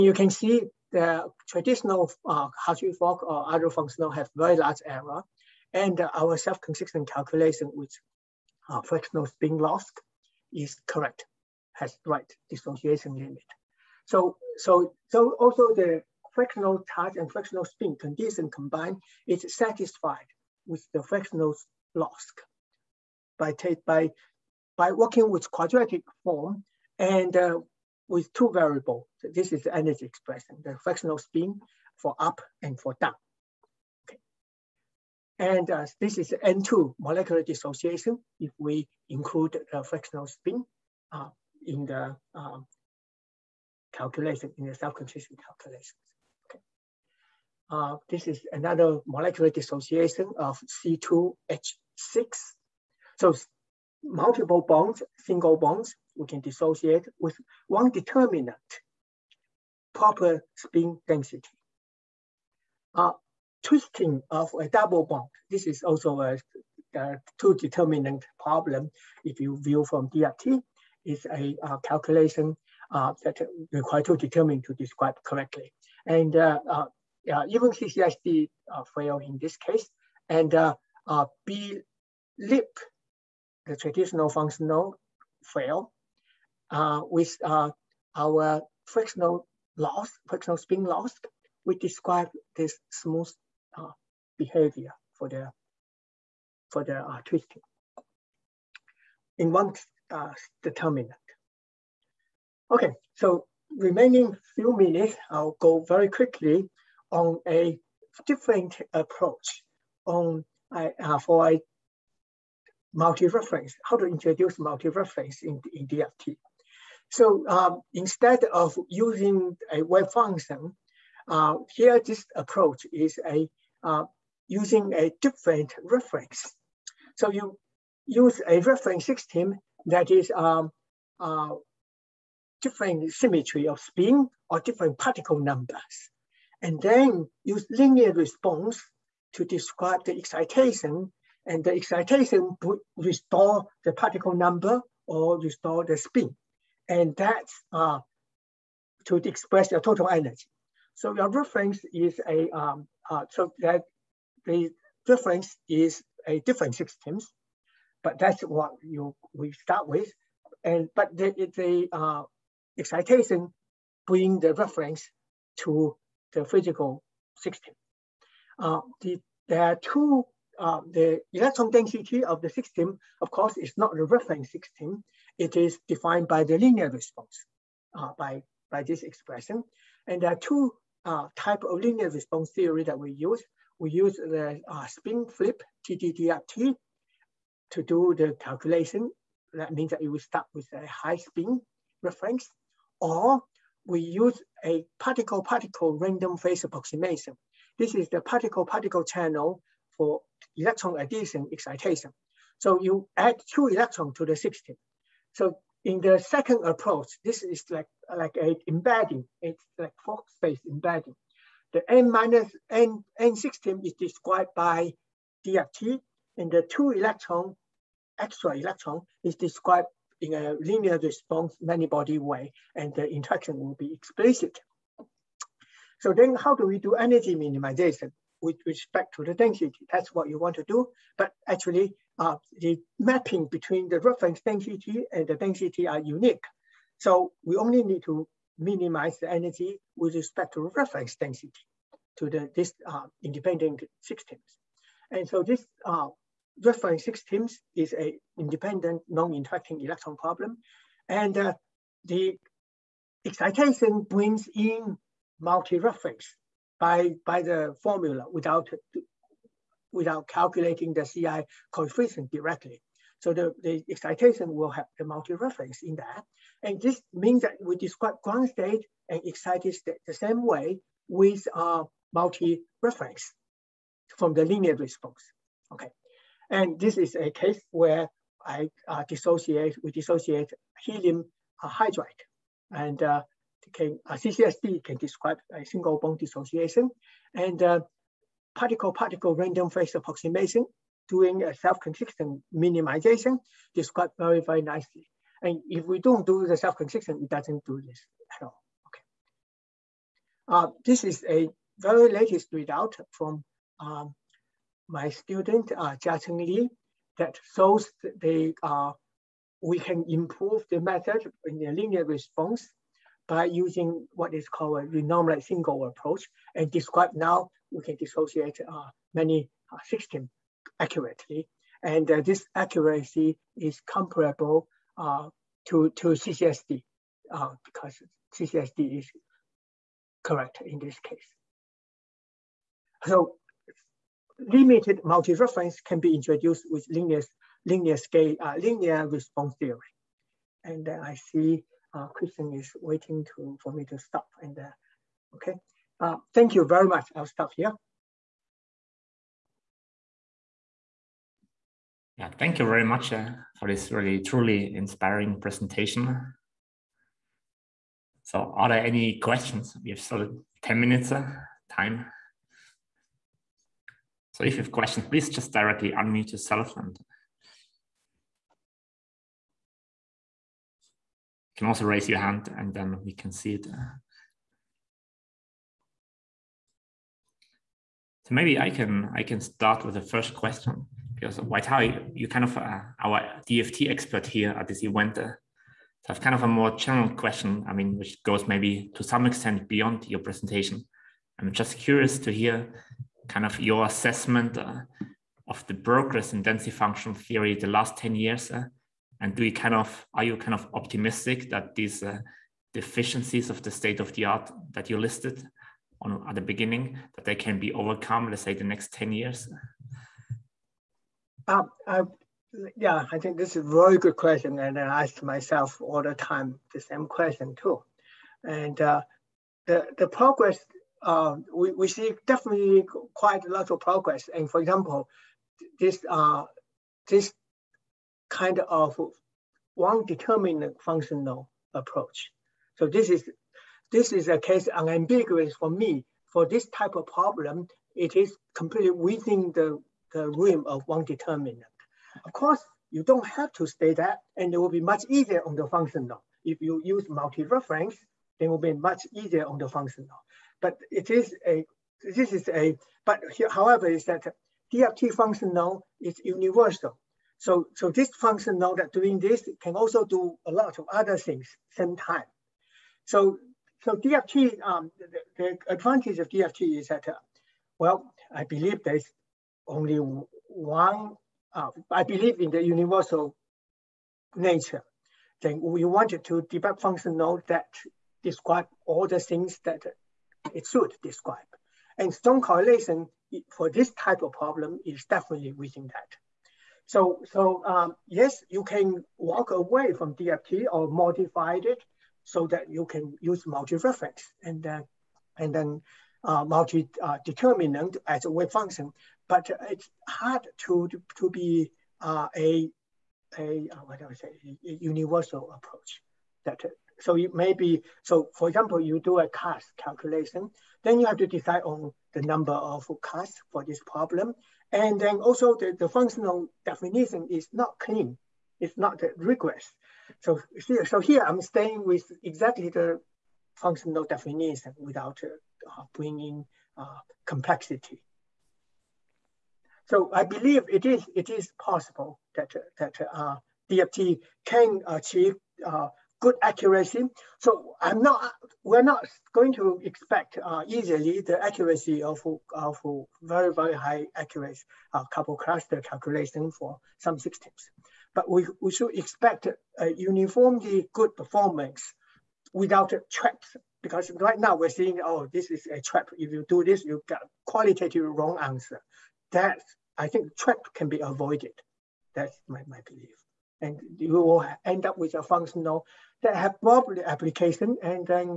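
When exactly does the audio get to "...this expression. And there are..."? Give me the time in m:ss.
2:58.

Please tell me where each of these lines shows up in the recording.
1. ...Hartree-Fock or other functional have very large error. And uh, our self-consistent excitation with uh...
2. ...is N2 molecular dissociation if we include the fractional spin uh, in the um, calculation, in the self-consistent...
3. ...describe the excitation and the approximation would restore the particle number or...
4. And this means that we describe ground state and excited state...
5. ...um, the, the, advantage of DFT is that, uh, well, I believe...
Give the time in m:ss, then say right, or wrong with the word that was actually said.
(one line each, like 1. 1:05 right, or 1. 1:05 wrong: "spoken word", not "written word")
1. 0:02 wrong: "calculation", not "excitation"
2. 0:36 right
3. 2:19 wrong: "excitation", not "approximation"
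4. 4:26 right
5. 7:44 right.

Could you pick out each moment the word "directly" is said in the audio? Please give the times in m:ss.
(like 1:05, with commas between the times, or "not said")
4:22, 6:05.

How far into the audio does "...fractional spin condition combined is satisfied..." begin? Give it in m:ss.
0:17.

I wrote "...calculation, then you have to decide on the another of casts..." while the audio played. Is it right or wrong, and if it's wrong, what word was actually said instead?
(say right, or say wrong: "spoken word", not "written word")
wrong: "number", not "another".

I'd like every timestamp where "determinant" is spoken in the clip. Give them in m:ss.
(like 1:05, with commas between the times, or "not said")
0:57, 1:07, 1:14, 1:40, 7:10, 7:21, 8:16.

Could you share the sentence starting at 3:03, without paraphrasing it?
We use the uh, spin flip, TDDFT, to do the calculation.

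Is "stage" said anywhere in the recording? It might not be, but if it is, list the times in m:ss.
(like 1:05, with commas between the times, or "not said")
not said.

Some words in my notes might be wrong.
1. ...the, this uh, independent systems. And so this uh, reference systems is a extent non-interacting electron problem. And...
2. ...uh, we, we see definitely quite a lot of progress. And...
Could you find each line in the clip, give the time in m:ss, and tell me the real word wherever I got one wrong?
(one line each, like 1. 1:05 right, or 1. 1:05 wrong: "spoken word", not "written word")
1. 4:02 wrong: "independent", not "extent"
2. 7:01 right.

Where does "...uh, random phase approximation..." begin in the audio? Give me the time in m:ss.
4:49.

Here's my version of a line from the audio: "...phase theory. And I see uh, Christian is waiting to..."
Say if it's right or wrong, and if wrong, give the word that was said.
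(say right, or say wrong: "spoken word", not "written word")
wrong: "response", not "phase".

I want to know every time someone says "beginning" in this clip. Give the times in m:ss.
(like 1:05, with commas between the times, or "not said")
6:46.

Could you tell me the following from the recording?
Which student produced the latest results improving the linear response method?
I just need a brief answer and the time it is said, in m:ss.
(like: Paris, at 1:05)
Jiacheng Li, at 5:05.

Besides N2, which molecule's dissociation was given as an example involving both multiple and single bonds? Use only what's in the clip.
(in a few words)
C2H6.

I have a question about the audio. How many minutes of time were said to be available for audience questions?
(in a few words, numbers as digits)
10.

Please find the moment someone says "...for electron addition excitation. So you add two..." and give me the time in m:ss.
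3:19.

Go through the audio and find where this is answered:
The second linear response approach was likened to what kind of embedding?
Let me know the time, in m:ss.
3:30.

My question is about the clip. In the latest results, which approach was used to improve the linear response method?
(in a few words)
renormalized single approach.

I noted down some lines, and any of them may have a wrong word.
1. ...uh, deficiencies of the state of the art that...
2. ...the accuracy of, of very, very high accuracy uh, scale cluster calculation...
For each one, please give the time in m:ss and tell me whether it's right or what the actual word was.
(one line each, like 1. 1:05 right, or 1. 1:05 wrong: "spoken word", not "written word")
1. 6:42 right
2. 9:01 wrong: "couple", not "scale".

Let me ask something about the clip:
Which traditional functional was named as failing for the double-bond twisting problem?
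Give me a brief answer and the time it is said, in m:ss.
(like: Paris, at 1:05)
B lip, at 1:21.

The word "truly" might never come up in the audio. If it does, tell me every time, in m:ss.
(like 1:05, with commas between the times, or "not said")
5:54.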